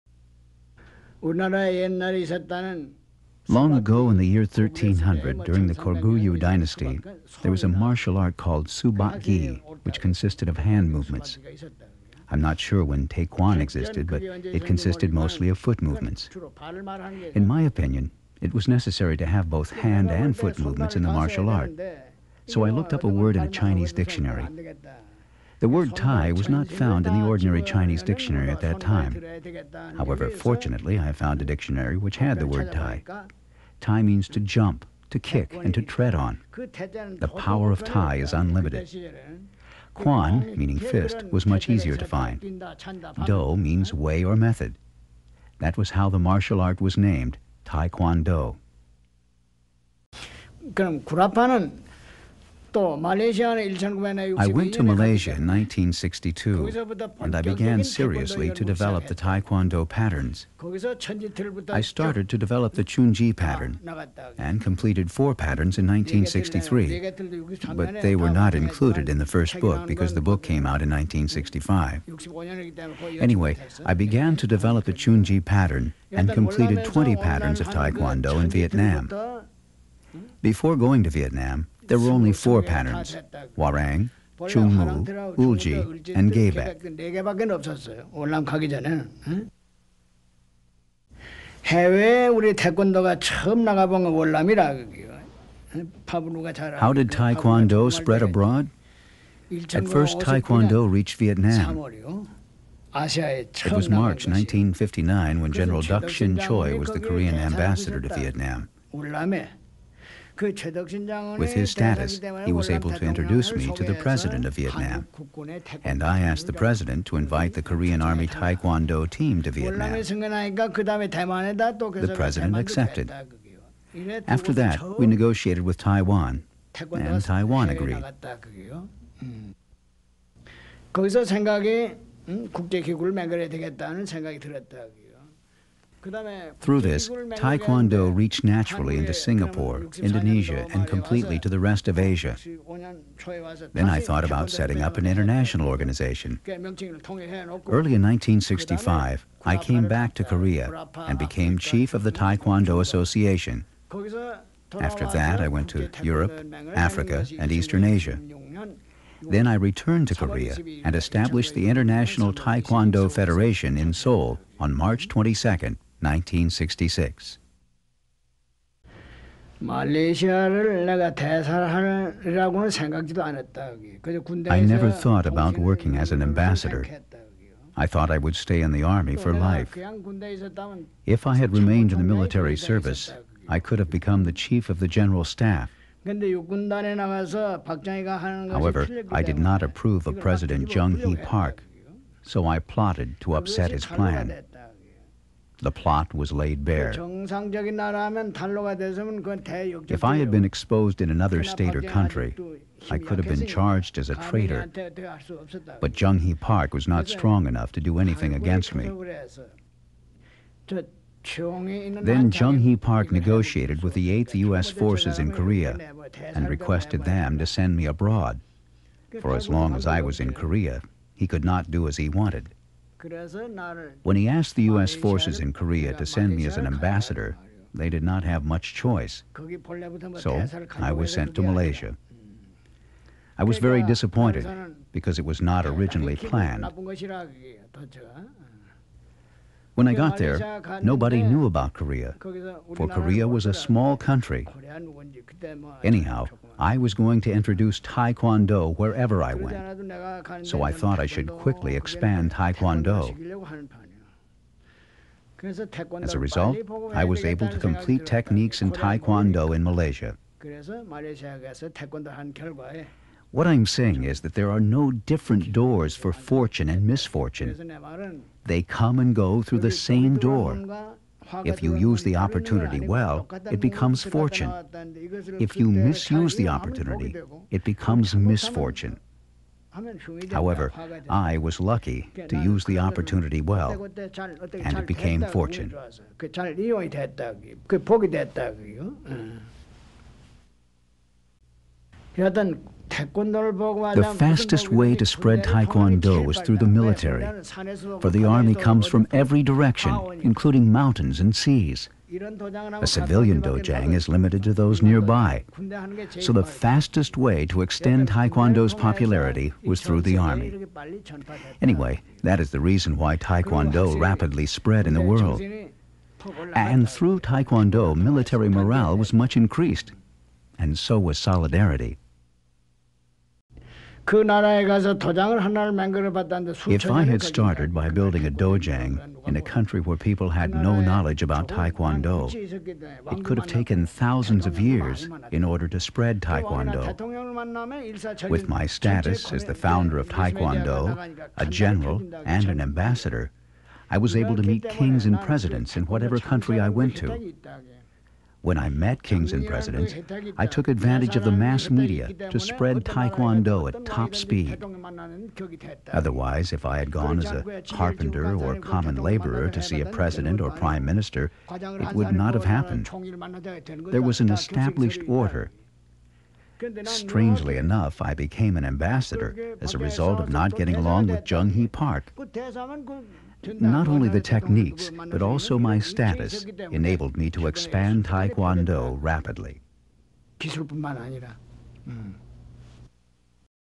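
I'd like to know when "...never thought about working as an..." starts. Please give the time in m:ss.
2:54.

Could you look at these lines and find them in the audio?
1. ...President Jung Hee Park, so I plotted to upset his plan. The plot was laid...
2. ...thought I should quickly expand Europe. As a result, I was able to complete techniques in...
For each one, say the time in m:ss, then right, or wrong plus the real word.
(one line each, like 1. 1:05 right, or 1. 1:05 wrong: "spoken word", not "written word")
1. 3:10 right
2. 4:10 wrong: "Taekwondo", not "Europe".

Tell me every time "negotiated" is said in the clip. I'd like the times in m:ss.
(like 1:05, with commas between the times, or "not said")
2:05, 3:33.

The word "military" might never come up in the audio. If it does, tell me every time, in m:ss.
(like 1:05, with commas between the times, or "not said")
3:02, 4:56, 5:17.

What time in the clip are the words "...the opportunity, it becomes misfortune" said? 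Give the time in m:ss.
4:36.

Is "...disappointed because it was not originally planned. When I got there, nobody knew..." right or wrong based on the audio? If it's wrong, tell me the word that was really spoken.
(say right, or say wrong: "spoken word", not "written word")
right.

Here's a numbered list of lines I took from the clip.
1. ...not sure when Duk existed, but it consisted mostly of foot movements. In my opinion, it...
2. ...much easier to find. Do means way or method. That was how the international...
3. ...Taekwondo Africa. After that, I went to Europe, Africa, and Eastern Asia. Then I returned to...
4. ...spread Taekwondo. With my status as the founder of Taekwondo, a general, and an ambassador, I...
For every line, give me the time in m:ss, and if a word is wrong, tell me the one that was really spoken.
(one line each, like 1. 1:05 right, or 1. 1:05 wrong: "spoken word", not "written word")
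1. 0:12 wrong: "Taekkyon", not "Duk"
2. 0:41 wrong: "martial", not "international"
3. 2:32 wrong: "Association", not "Africa"
4. 5:35 right.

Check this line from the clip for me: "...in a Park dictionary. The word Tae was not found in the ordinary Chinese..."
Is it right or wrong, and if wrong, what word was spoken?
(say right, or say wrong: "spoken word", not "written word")
wrong: "Chinese", not "Park".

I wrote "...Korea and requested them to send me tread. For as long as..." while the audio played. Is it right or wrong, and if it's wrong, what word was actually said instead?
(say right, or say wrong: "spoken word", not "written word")
wrong: "abroad", not "tread".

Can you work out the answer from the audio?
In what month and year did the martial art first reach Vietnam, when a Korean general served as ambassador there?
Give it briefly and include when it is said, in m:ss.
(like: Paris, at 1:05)
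March 1959, at 1:43.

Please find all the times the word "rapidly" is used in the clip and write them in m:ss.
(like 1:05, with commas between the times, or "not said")
5:13, 6:19.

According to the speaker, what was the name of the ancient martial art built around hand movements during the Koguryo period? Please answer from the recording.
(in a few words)
Subak.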